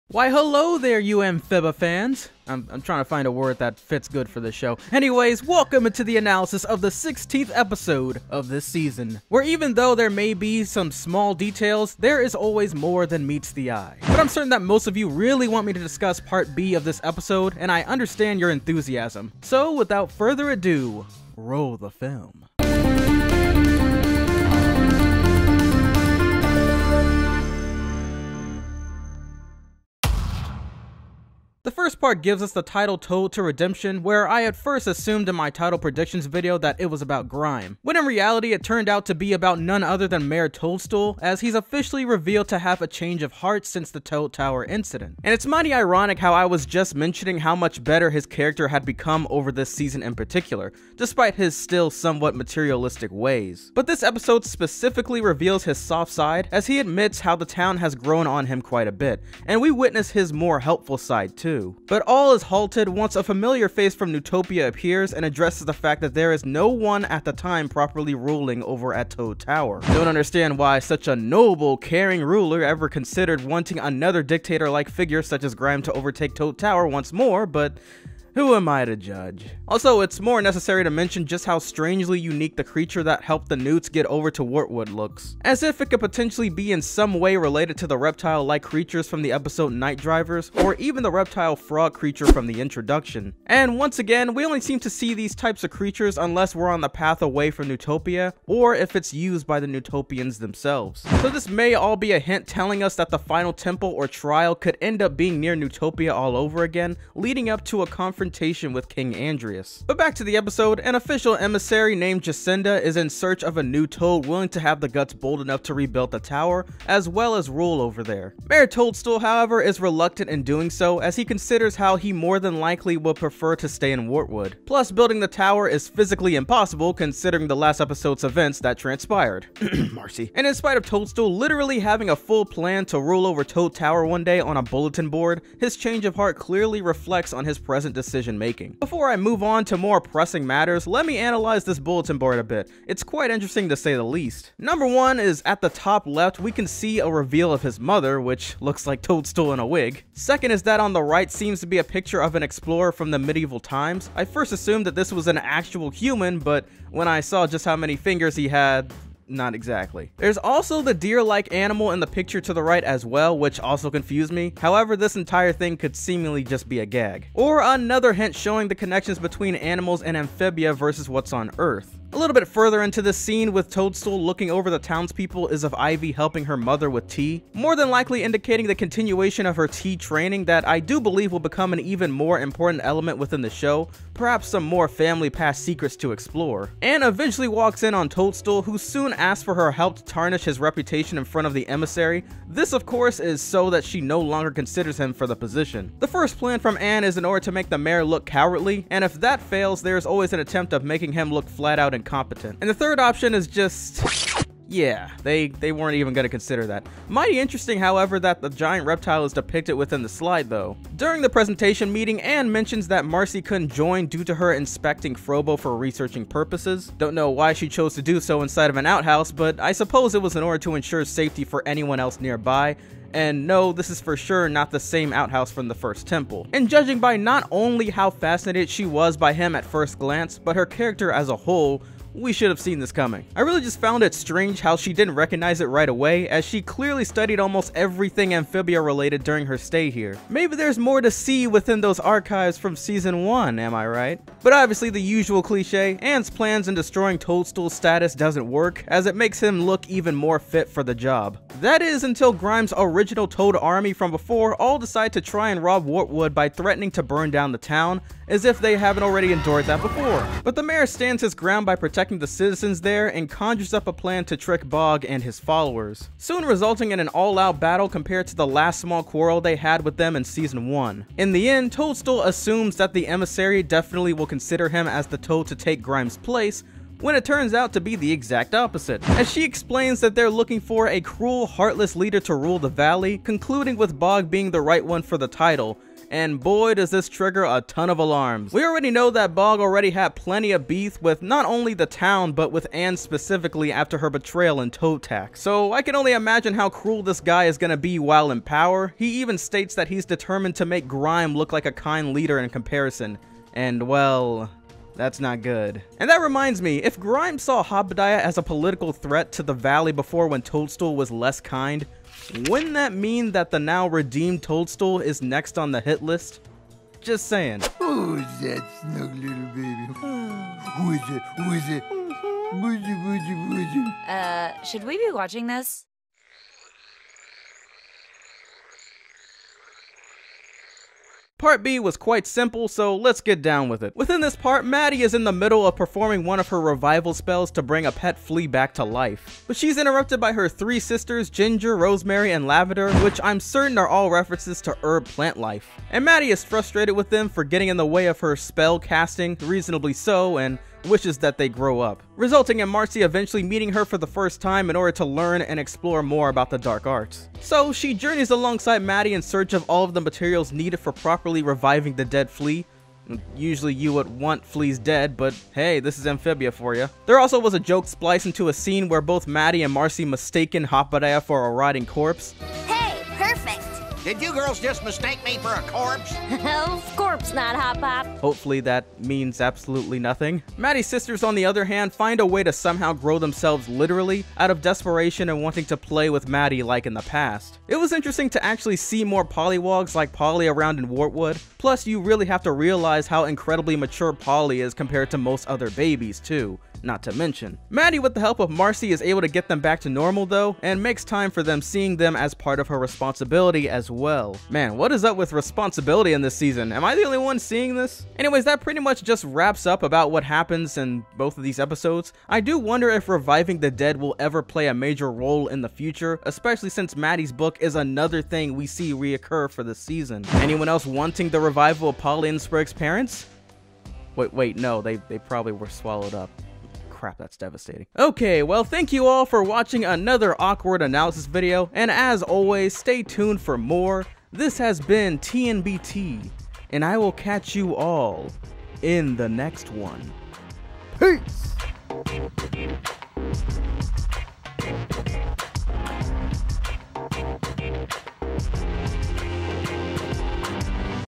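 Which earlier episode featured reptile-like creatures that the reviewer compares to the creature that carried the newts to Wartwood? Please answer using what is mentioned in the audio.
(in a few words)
Night Drivers.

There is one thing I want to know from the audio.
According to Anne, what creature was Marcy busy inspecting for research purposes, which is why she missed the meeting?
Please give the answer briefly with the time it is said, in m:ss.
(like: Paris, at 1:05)
Frobo, at 3:35.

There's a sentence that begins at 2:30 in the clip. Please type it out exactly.
Second is that on the right seems to be a picture of an explorer from the medieval times.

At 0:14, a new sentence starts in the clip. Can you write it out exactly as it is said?
But I'm certain that most of you really want me to discuss part B of this episode, and I understand your enthusiasm.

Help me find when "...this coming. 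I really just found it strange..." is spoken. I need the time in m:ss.
3:52.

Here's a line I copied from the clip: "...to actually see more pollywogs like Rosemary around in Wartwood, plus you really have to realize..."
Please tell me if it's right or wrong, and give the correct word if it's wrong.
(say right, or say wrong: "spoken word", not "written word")
wrong: "Polly", not "Rosemary".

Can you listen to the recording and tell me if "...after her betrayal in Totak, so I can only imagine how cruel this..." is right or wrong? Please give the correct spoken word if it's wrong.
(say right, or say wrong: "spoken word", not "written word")
right.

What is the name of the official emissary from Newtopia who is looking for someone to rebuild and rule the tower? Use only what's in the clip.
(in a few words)
Jacinda.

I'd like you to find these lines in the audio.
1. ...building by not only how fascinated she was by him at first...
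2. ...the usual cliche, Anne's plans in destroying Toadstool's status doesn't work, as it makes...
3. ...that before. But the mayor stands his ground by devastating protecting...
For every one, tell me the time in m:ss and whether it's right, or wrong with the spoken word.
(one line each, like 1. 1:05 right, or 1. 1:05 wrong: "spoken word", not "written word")
1. 3:46 wrong: "judging", not "building"
2. 4:04 right
3. 4:19 wrong: "protecting", not "devastating".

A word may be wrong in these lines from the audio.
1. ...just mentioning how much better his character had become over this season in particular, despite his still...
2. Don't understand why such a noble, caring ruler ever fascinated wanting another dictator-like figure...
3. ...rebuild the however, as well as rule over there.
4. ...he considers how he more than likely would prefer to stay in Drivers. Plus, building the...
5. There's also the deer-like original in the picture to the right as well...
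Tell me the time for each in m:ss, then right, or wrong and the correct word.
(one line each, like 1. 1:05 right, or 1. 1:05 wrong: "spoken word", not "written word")
1. 0:46 right
2. 1:09 wrong: "considered", not "fascinated"
3. 1:55 wrong: "tower", not "however"
4. 2:01 wrong: "Wartwood", not "Drivers"
5. 2:40 wrong: "animal", not "original".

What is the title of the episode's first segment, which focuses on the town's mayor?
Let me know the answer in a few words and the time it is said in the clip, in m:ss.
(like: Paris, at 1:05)
Toad to Redemption, at 0:32.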